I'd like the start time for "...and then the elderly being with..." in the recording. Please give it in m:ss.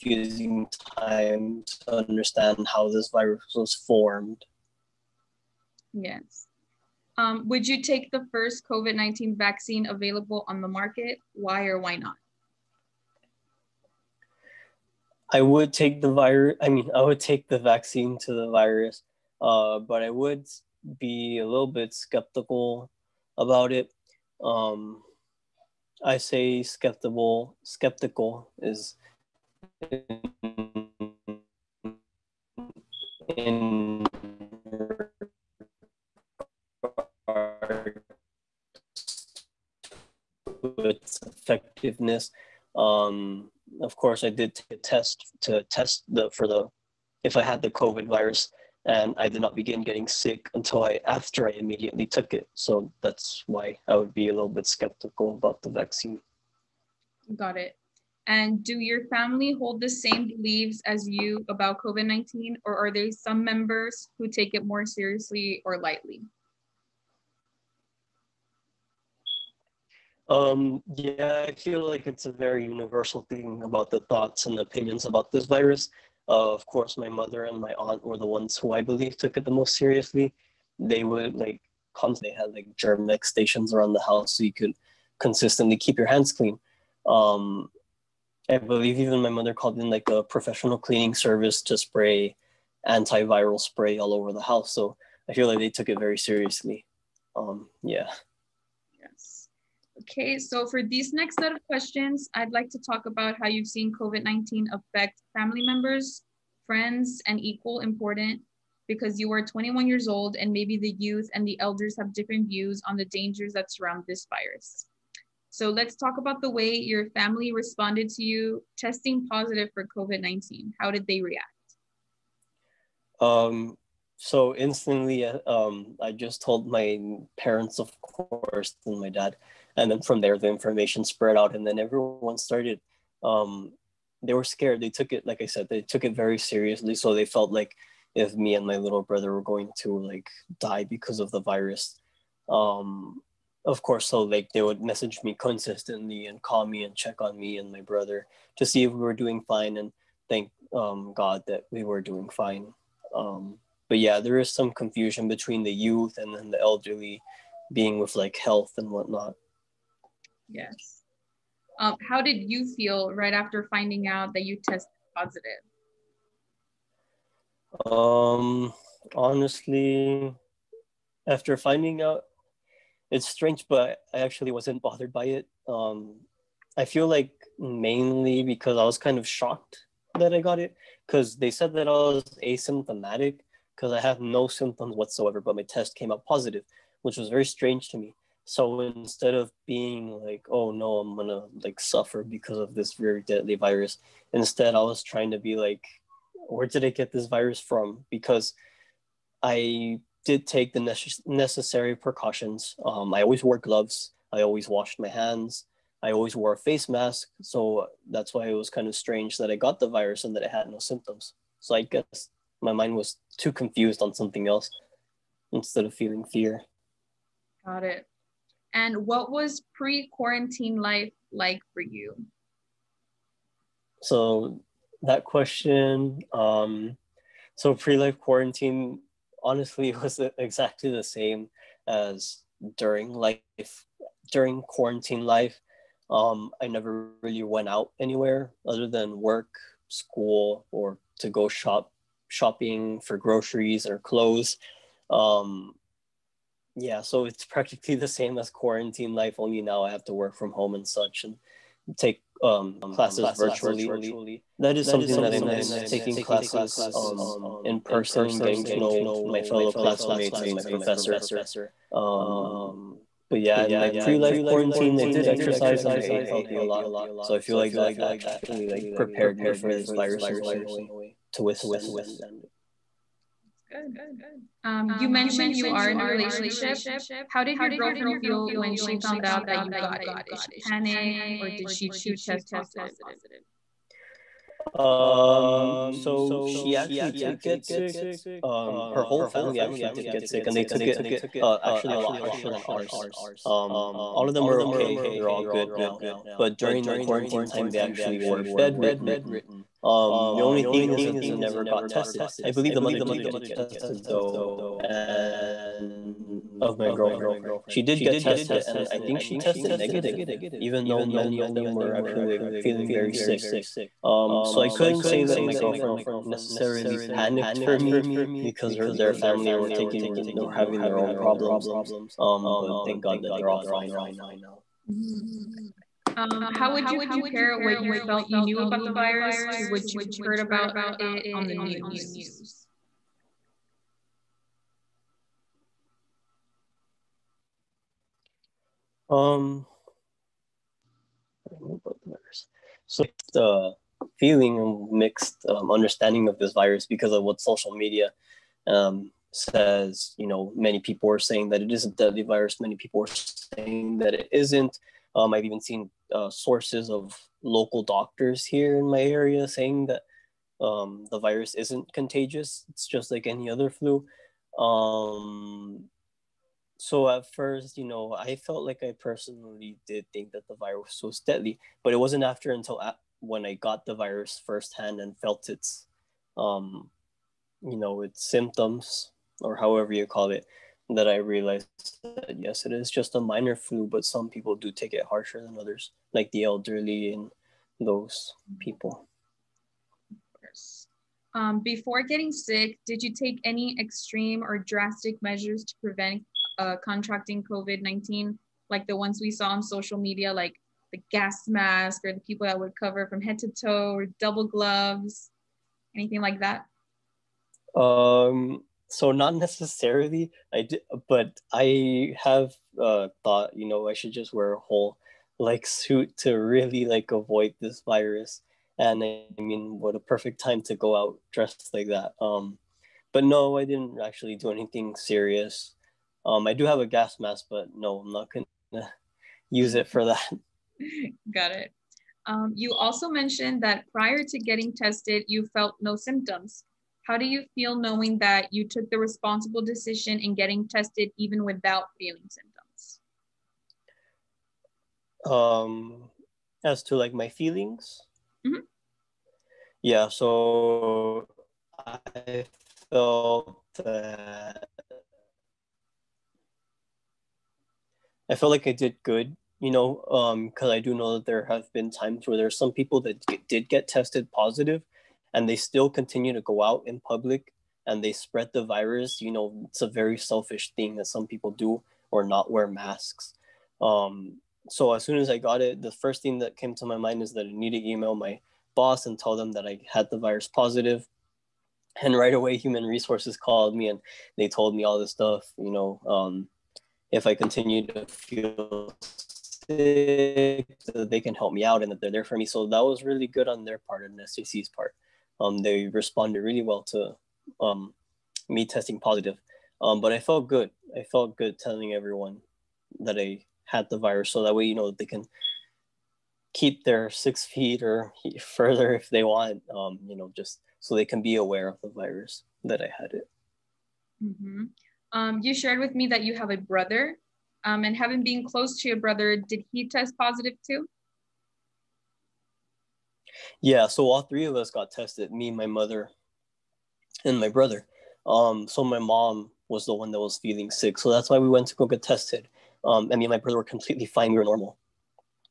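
2:36.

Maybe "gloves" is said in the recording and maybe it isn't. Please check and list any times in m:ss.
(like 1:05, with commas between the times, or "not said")
3:23, 6:44.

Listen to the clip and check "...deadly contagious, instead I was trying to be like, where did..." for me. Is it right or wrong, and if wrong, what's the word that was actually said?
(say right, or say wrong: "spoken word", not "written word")
wrong: "virus", not "contagious".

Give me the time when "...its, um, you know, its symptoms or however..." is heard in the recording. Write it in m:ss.
6:15.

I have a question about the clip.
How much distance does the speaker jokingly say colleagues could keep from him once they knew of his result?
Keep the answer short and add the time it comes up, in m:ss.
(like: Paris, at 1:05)
6 feet, at 8:27.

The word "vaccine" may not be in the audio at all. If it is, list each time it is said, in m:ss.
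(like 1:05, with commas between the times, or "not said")
0:09, 0:17, 0:55.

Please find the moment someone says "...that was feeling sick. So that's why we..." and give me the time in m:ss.
8:50.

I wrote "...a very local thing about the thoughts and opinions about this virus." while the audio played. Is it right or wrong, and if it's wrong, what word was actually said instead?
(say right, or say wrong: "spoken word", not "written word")
wrong: "universal", not "local".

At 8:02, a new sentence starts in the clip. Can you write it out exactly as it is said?
And right away, human resources called me and they told me all this stuff.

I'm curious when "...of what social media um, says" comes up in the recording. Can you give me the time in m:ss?
5:47.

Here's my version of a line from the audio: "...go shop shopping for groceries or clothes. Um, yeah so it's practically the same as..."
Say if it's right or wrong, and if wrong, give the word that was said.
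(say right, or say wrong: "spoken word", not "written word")
right.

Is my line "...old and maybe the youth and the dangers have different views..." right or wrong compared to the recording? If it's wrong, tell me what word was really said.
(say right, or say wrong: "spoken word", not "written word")
wrong: "elders", not "dangers".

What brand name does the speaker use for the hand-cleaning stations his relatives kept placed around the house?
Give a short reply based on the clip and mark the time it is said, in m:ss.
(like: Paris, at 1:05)
Germex, at 1:22.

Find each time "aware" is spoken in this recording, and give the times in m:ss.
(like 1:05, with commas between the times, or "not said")
8:31.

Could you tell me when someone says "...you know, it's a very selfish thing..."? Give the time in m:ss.
7:49.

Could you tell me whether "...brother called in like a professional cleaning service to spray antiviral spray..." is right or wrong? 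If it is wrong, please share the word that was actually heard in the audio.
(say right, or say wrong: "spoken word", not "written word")
wrong: "mother", not "brother".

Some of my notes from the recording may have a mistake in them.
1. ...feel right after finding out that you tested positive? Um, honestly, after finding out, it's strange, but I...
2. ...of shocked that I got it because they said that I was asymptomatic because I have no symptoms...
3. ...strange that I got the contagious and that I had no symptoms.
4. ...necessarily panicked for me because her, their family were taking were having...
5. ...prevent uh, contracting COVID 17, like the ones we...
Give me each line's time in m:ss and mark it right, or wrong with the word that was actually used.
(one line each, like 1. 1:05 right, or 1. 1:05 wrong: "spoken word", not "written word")
1. 2:42 right
2. 2:59 right
3. 3:28 wrong: "virus", not "contagious"
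4. 5:16 right
5. 6:35 wrong: "19", not "17".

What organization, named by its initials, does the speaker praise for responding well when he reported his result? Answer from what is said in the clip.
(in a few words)
STC.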